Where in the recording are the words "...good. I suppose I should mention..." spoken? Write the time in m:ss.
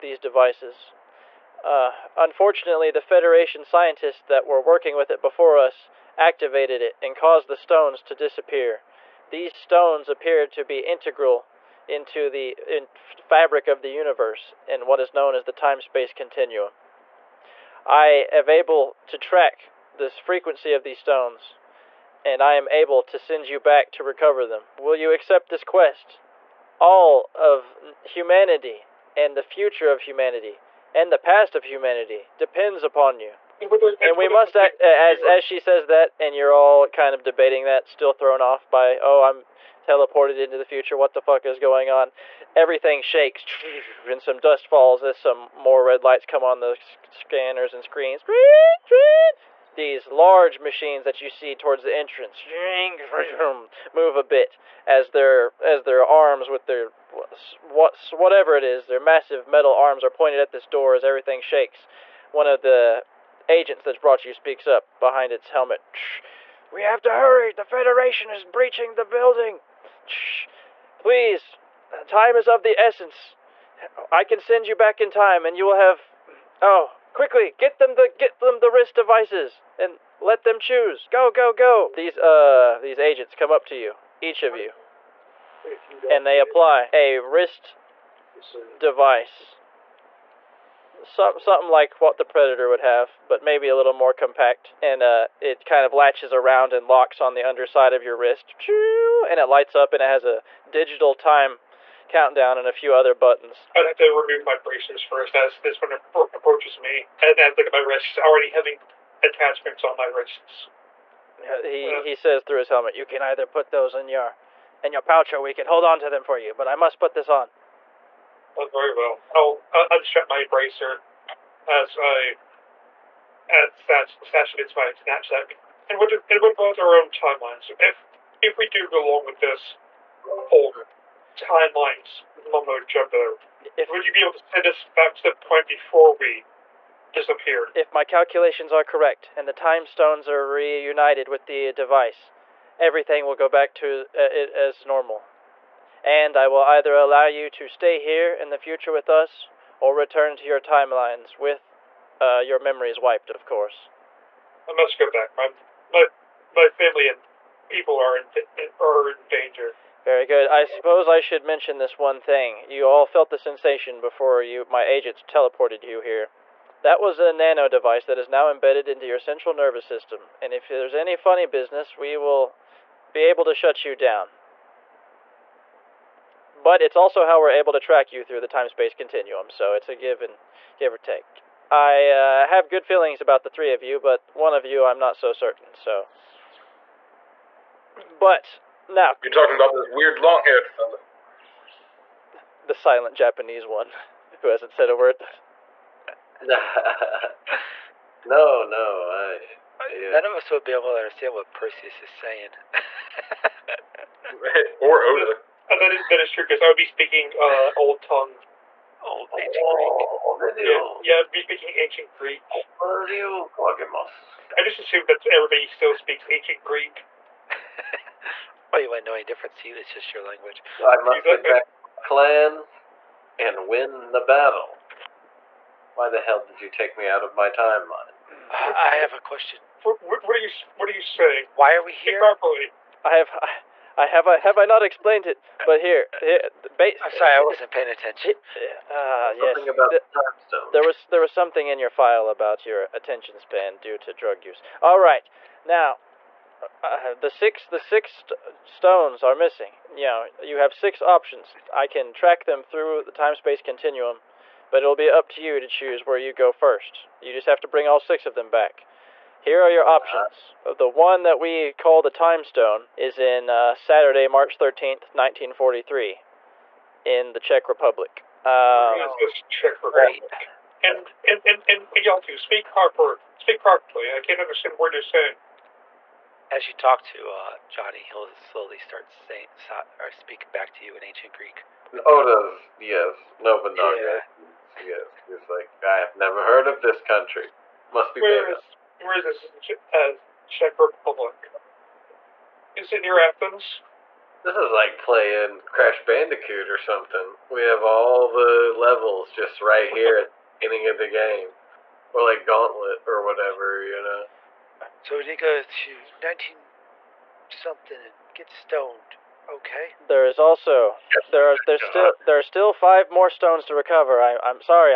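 2:40.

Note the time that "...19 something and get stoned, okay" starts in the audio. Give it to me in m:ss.
5:06.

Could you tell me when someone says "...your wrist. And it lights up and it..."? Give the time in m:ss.
1:38.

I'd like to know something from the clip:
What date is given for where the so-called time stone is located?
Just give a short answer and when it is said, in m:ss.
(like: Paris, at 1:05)
Saturday, March 13th, 1943, at 4:23.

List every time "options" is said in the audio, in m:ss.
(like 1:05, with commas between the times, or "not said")
4:11, 4:19.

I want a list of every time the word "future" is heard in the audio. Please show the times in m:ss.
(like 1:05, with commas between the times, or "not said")
0:29, 0:40, 2:28.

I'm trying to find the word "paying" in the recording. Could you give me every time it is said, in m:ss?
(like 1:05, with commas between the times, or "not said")
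3:57.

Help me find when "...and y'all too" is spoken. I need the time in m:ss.
4:31.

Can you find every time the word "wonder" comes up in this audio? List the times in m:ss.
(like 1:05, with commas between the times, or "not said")
not said.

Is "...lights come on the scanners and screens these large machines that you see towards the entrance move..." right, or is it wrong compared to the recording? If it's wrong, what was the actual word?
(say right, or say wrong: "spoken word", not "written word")
right.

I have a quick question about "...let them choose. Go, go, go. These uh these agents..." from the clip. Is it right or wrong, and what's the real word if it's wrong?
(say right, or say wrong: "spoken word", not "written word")
right.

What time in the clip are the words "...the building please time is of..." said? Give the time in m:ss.
1:08.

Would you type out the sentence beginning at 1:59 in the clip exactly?
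I'll, I'll unstrap my bracer as I as stash into my knapsack.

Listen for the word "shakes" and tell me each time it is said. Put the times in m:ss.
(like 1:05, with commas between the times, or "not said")
0:43, 1:01.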